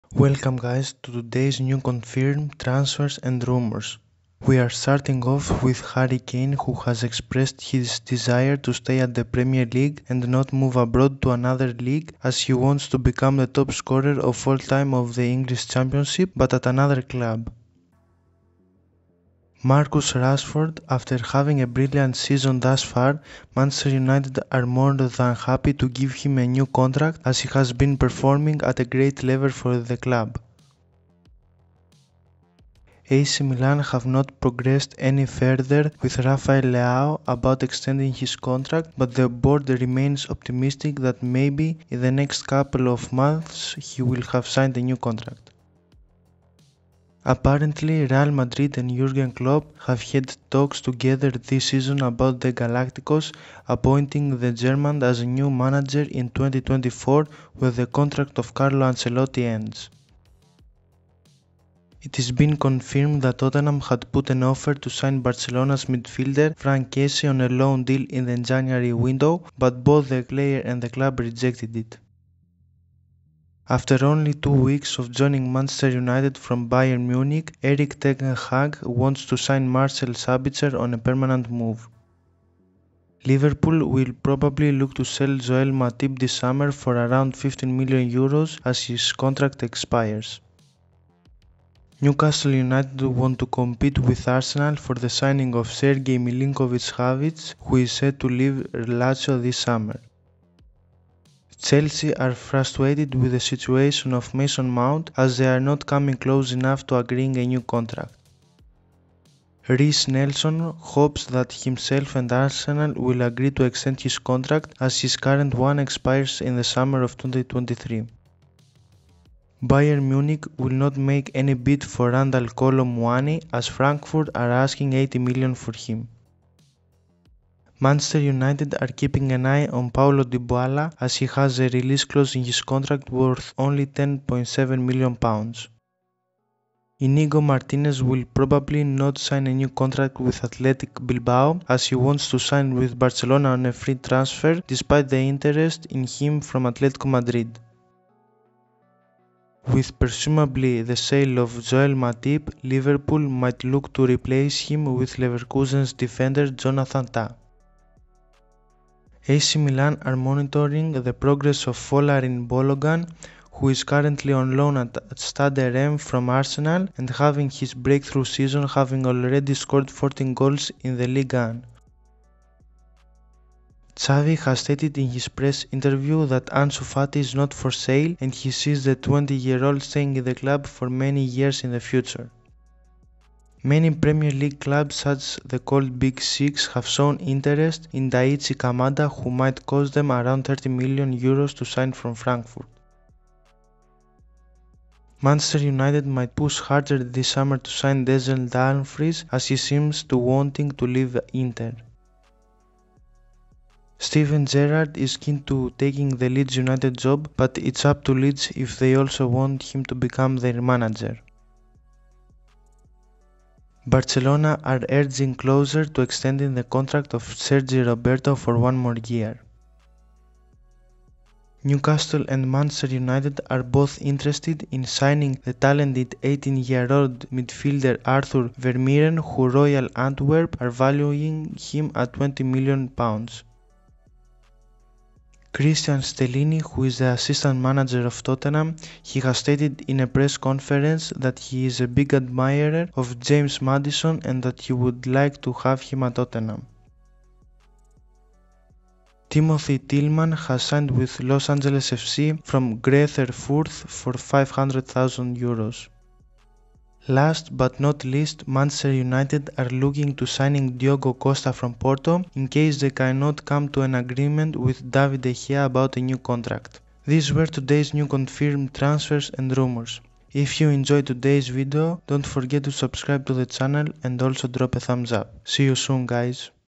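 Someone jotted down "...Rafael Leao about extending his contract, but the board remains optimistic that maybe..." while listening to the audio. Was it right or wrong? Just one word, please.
right.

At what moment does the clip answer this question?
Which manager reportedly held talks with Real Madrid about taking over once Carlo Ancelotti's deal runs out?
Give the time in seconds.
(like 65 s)
48 s.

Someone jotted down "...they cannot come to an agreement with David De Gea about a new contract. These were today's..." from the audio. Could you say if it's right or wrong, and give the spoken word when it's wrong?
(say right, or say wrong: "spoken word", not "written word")
right.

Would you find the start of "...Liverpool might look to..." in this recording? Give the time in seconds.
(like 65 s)
152 s.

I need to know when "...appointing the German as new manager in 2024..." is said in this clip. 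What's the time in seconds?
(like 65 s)
53 s.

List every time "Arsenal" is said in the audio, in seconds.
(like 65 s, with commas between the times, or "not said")
94 s, 112 s, 166 s.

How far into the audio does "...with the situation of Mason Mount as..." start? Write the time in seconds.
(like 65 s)
103 s.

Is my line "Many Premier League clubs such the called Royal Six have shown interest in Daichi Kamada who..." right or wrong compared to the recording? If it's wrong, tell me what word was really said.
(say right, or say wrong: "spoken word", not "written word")
wrong: "Big", not "Royal".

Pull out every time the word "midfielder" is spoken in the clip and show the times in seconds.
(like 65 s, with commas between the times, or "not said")
65 s, 227 s.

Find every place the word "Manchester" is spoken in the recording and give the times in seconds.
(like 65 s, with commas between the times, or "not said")
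23 s, 75 s, 127 s, 195 s, 222 s, 258 s.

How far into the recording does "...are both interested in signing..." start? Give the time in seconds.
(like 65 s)
223 s.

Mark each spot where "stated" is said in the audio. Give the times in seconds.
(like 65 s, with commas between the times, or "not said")
174 s, 239 s.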